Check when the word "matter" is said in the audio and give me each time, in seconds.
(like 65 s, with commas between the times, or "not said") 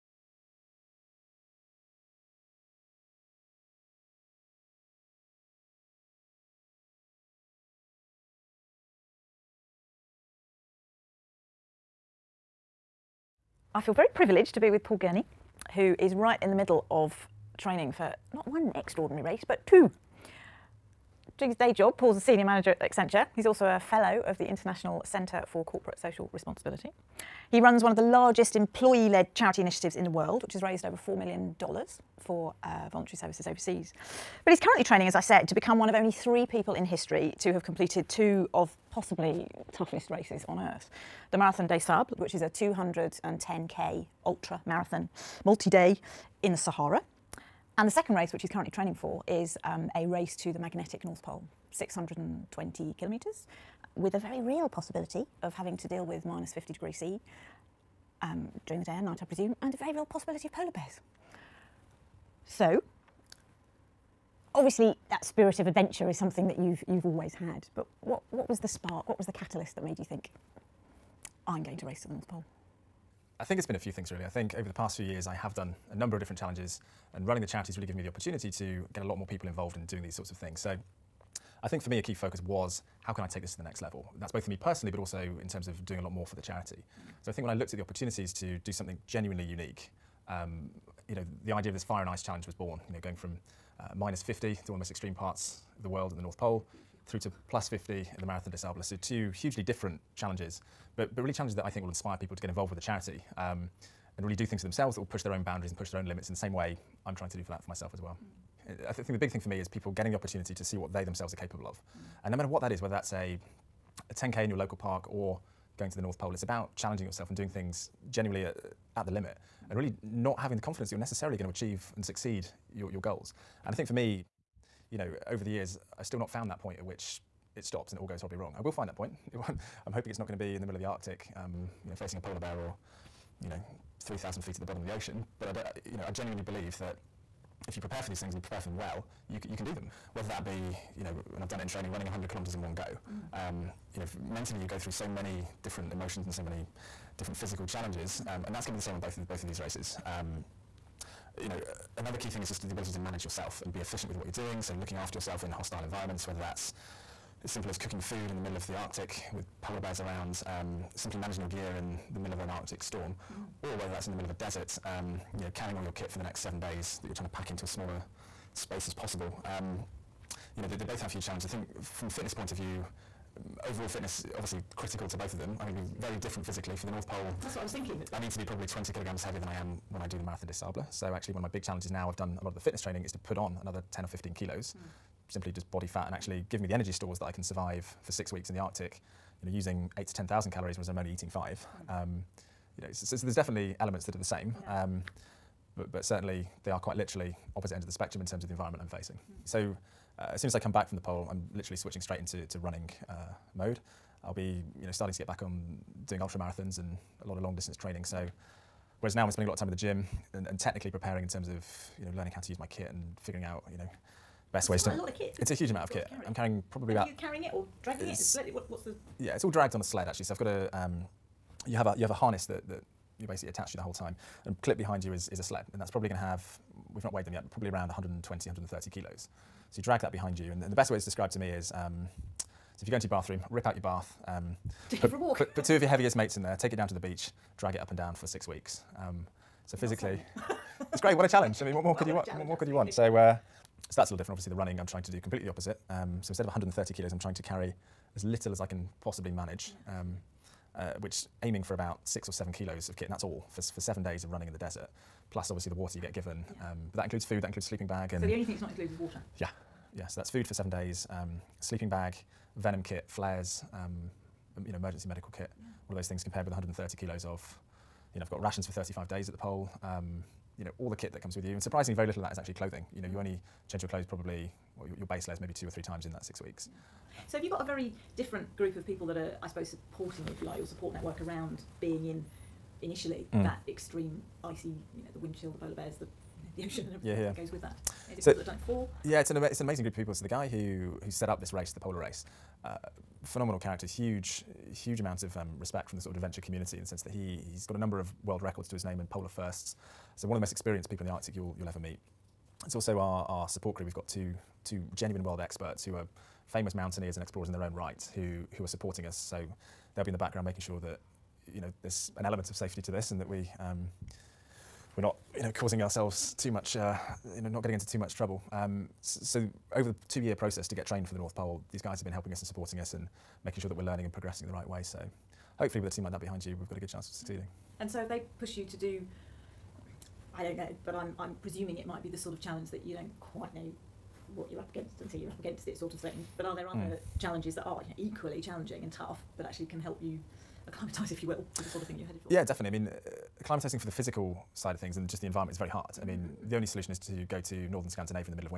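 112 s.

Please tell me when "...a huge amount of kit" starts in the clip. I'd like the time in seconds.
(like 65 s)
215 s.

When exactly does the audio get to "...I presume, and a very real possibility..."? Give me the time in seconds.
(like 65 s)
59 s.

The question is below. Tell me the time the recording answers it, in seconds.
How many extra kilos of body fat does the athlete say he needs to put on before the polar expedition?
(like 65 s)
183 s.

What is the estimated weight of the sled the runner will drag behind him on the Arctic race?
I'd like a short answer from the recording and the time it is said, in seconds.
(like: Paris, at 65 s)
120-130 kilos, at 227 s.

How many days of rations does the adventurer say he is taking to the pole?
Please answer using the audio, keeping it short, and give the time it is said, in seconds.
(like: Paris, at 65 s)
35 days, at 268 s.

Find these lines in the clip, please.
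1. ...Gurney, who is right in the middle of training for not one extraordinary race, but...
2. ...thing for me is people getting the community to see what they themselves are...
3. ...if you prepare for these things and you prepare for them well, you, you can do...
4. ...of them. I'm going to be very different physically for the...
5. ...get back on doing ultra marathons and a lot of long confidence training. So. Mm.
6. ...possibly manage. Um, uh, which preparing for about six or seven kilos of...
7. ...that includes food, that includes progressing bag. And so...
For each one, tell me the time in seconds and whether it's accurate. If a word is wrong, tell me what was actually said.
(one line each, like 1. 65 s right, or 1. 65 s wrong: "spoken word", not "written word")
1. 14 s right
2. 109 s wrong: "opportunity", not "community"
3. 137 s right
4. 175 s right
5. 205 s wrong: "distance", not "confidence"
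6. 249 s wrong: "aiming", not "preparing"
7. 256 s wrong: "sleeping", not "progressing".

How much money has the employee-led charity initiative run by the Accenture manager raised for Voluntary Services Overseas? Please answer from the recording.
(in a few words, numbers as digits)
over $4 million.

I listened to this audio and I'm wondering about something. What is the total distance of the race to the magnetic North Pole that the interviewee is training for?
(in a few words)
620 kilometres.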